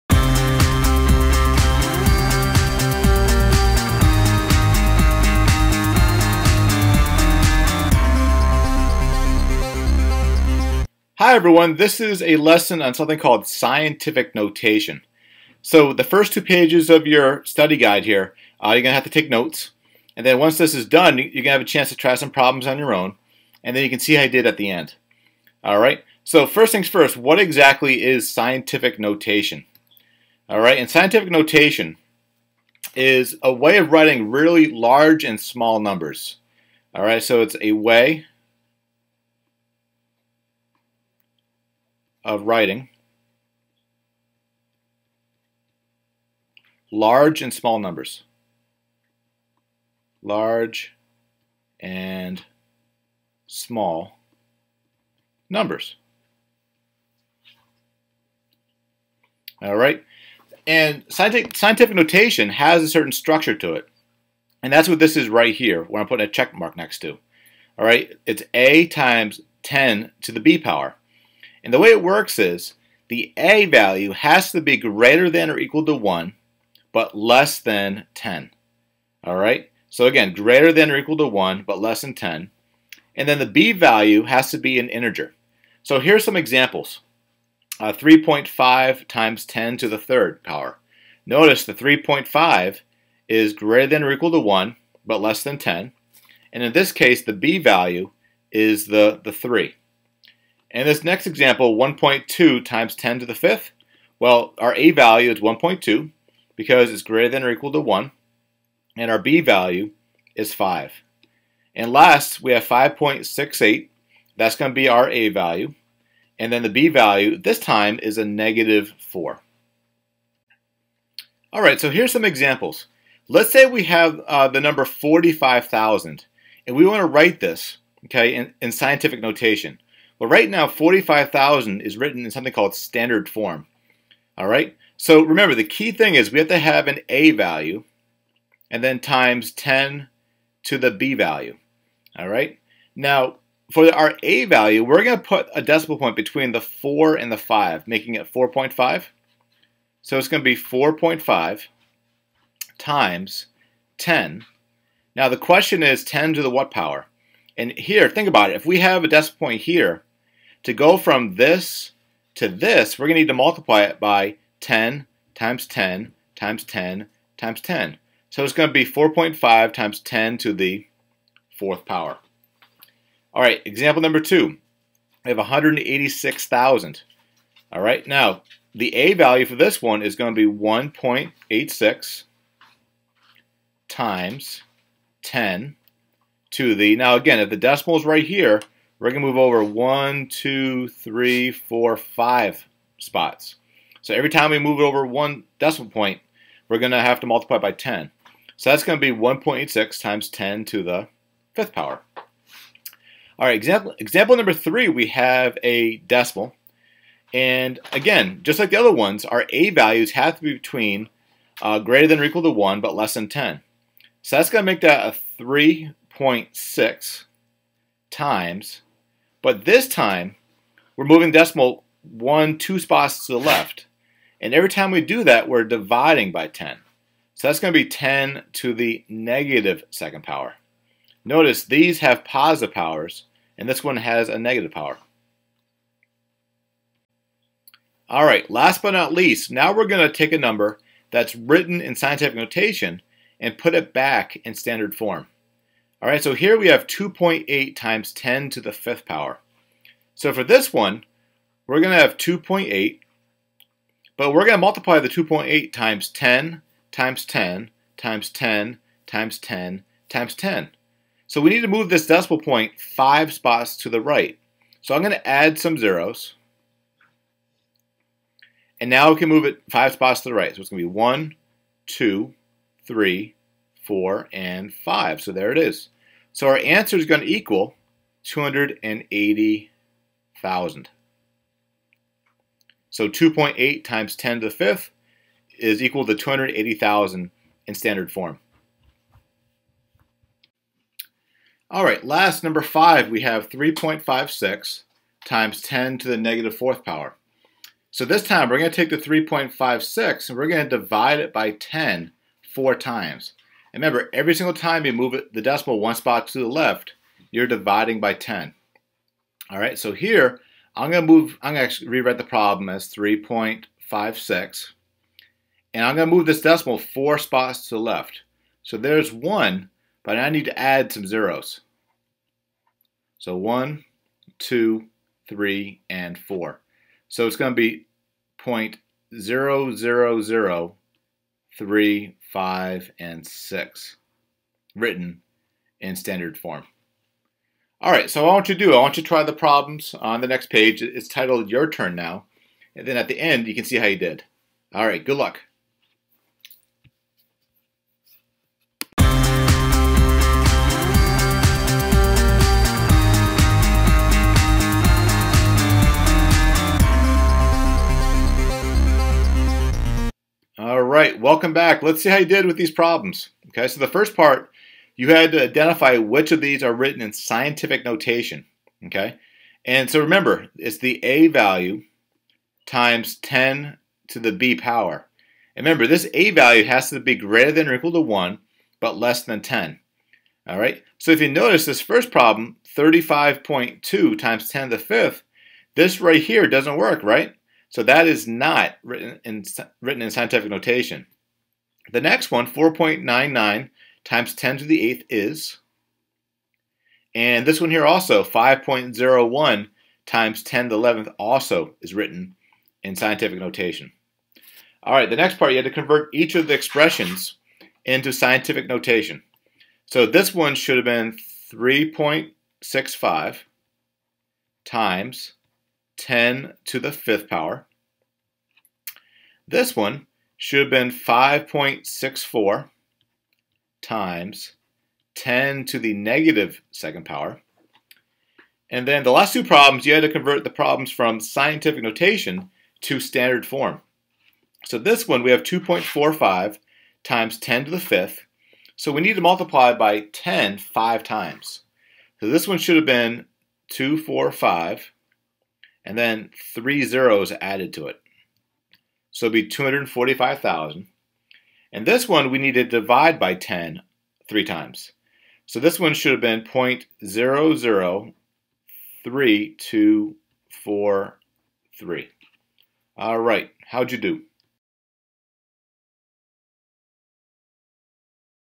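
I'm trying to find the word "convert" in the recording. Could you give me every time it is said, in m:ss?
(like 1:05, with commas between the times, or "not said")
6:45, 7:10.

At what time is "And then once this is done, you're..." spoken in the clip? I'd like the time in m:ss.
0:20.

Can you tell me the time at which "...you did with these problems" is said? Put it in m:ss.
6:02.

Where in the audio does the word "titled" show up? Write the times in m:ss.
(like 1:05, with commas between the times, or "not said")
5:41.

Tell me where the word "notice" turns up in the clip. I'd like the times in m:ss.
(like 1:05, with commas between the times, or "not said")
1:31, 3:51, 6:21.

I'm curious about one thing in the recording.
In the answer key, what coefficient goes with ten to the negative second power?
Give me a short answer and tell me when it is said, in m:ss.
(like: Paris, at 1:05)
5.64, at 7:00.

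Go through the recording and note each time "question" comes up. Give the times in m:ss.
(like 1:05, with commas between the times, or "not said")
2:35.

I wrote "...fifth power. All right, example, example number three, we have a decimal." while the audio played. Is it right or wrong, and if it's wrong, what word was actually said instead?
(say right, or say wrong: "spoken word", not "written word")
right.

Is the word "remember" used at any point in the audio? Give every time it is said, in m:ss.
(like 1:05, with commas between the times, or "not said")
2:15, 5:03, 6:09, 6:15.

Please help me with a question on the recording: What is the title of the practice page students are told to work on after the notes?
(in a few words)
Your Turn Now.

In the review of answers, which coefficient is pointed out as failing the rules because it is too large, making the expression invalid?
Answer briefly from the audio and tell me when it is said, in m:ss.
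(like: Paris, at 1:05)
35.2, at 6:22.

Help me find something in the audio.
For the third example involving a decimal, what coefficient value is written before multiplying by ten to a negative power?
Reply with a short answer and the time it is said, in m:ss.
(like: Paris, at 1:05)
3.6, at 3:35.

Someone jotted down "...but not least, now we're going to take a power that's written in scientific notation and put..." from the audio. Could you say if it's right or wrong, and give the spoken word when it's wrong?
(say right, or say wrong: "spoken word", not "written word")
wrong: "number", not "power".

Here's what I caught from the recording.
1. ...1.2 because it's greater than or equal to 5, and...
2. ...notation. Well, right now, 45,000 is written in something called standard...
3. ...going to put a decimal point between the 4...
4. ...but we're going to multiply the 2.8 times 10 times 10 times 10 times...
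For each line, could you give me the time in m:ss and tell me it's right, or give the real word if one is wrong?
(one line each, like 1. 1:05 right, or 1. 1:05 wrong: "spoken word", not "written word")
1. 1:45 wrong: "1", not "5"
2. 2:09 right
3. 2:25 right
4. 4:14 right.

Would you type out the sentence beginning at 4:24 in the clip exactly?
So I'm going to add some zeros.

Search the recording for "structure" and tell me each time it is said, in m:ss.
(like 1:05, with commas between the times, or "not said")
1:03.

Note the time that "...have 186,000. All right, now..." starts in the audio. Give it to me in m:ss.
2:55.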